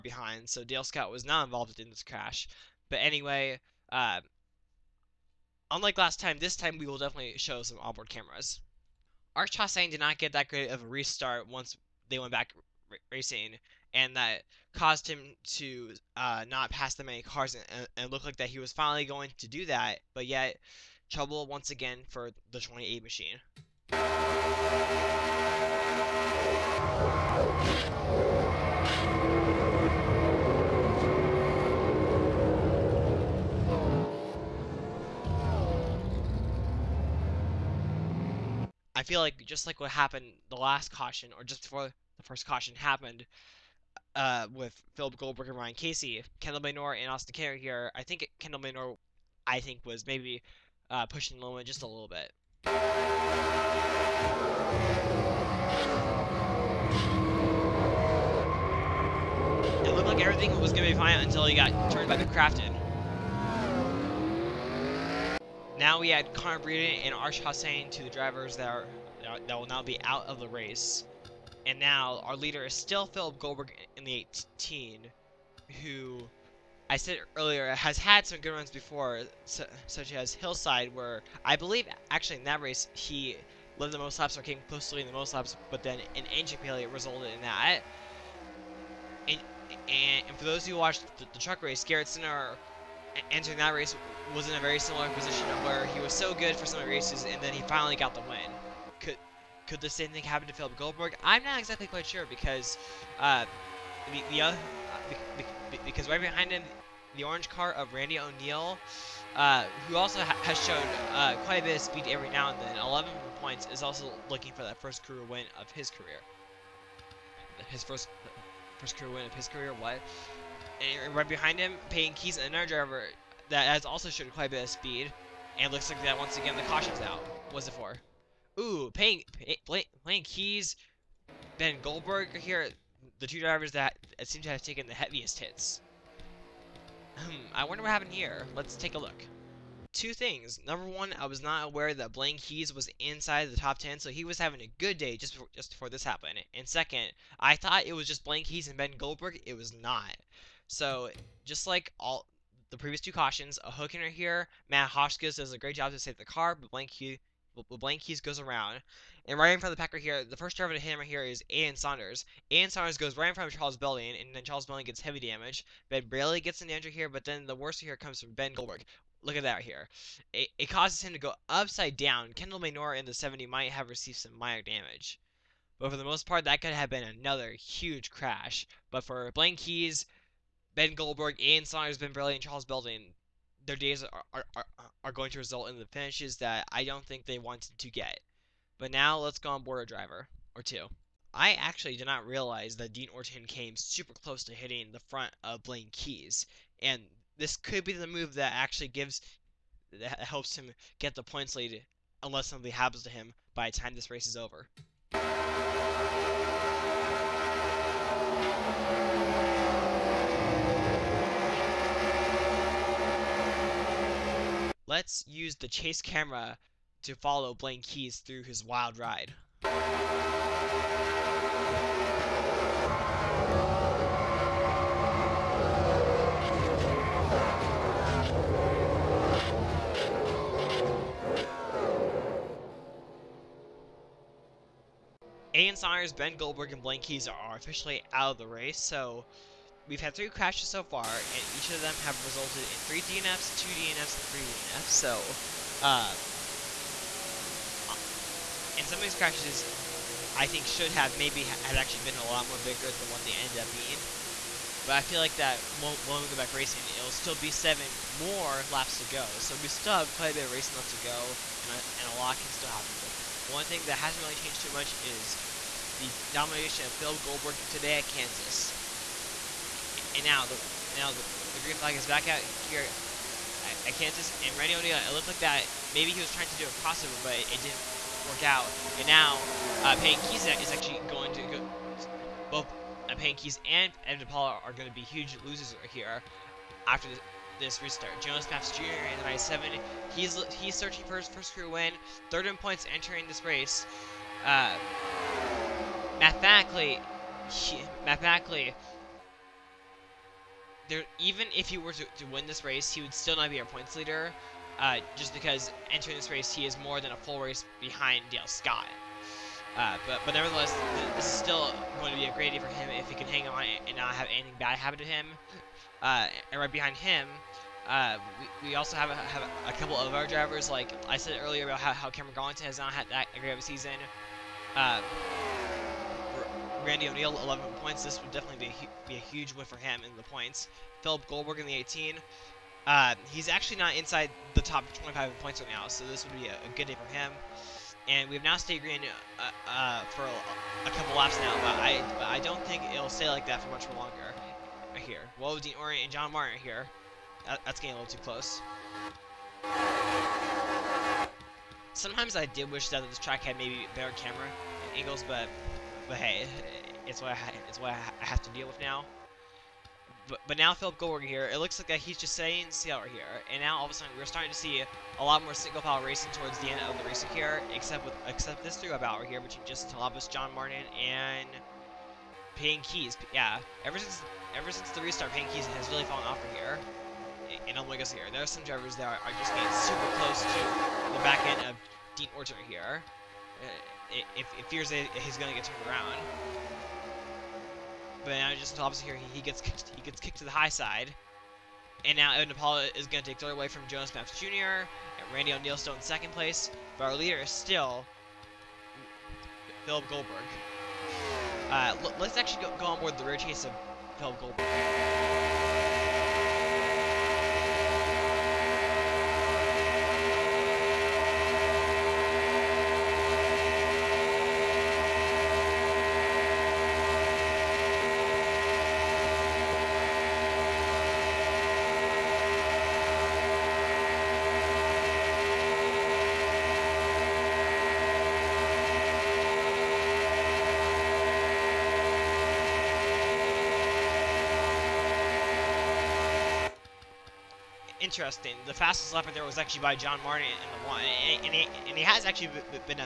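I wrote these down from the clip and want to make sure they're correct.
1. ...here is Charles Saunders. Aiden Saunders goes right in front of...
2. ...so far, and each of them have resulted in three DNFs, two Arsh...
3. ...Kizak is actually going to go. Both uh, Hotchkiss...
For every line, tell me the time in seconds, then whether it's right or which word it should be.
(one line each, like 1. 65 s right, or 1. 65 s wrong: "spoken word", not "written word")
1. 161 s wrong: "Aiden", not "Charles"
2. 240 s wrong: "DNFs", not "Arsh"
3. 280 s wrong: "Payne", not "Hotchkiss".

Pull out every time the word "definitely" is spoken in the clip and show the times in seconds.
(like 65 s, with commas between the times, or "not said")
6 s, 328 s.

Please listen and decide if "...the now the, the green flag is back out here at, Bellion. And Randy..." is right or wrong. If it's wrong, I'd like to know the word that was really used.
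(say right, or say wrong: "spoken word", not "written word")
wrong: "Kansas", not "Bellion".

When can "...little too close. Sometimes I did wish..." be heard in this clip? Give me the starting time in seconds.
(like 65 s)
348 s.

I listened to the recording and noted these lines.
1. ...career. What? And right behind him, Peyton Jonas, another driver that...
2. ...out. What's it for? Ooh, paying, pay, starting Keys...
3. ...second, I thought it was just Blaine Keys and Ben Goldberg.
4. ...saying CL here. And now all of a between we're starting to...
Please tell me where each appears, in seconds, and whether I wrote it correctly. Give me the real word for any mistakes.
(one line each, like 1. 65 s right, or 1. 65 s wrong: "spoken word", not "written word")
1. 119 s wrong: "Keys", not "Jonas"
2. 127 s wrong: "playing", not "starting"
3. 146 s right
4. 362 s wrong: "sudden", not "between".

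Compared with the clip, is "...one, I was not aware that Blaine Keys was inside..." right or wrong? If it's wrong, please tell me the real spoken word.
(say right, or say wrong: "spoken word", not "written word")
right.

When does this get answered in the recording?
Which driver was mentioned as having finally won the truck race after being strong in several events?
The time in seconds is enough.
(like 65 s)
91 s.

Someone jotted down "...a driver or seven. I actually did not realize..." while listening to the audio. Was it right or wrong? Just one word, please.
wrong.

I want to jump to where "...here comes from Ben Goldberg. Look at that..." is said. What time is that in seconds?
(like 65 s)
167 s.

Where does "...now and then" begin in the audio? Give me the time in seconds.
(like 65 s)
112 s.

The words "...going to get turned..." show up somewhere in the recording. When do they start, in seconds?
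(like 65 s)
385 s.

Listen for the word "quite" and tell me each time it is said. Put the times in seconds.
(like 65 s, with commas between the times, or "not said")
101 s, 111 s, 124 s, 260 s.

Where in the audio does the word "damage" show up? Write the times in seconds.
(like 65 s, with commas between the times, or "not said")
165 s, 174 s.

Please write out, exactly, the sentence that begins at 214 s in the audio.
Let's use the chase camera to follow Blaine Keys through his wild ride.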